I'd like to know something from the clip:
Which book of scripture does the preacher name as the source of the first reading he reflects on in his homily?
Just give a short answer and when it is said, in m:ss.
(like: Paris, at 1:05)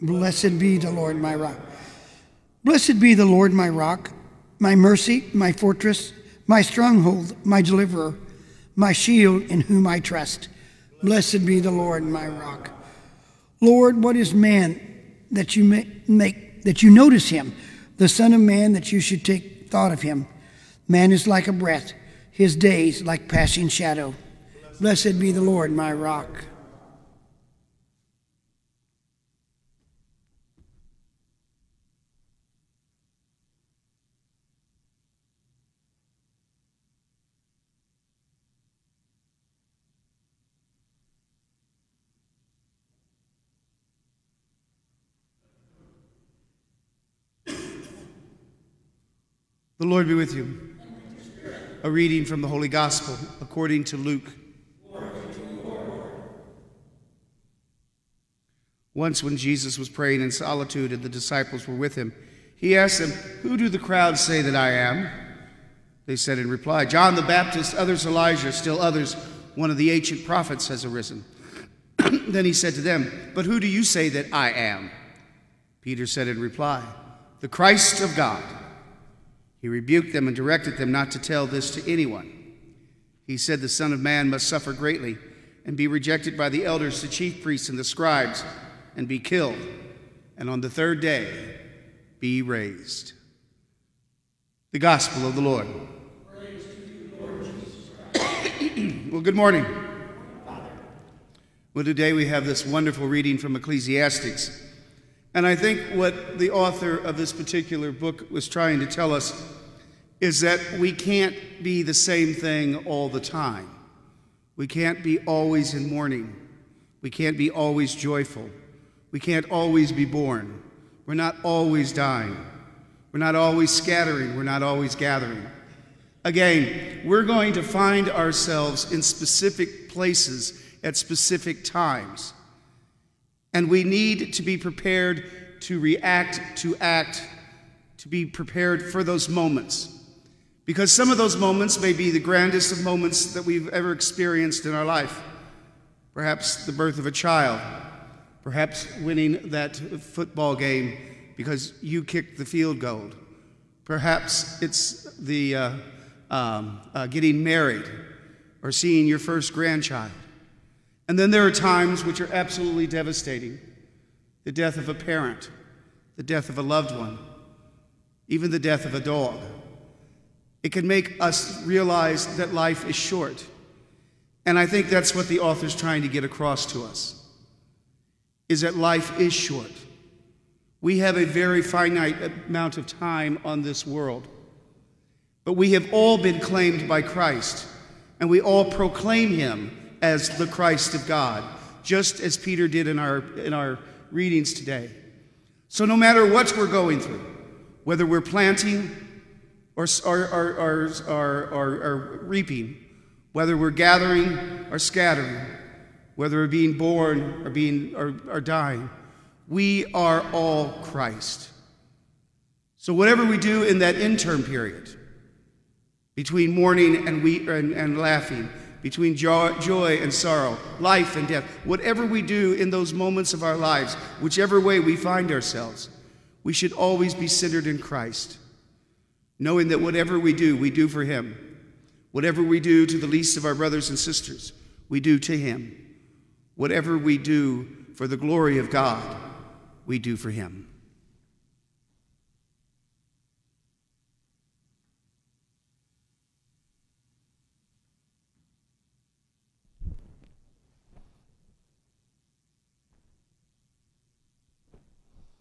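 Ecclesiastics, at 1:43.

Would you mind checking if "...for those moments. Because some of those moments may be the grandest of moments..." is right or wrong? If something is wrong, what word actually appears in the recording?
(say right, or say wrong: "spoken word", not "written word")
right.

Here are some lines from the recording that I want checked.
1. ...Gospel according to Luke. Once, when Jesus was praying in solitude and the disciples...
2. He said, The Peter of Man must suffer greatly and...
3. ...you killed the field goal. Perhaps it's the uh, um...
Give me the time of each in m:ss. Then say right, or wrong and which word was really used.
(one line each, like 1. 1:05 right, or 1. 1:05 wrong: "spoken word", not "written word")
1. 0:52 right
2. 1:23 wrong: "Son", not "Peter"
3. 2:31 wrong: "kicked", not "killed".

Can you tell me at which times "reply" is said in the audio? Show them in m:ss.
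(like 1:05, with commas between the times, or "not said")
1:06, 1:16.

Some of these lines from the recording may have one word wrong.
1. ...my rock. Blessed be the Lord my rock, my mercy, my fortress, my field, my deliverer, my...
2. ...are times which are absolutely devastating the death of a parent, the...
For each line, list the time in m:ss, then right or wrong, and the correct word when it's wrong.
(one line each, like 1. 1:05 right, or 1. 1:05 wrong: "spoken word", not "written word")
1. 0:01 wrong: "stronghold", not "field"
2. 2:41 right.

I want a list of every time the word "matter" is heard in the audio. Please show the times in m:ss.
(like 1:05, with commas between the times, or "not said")
3:15.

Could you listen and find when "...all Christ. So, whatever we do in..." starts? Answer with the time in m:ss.
3:30.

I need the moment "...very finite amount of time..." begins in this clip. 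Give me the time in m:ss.
3:01.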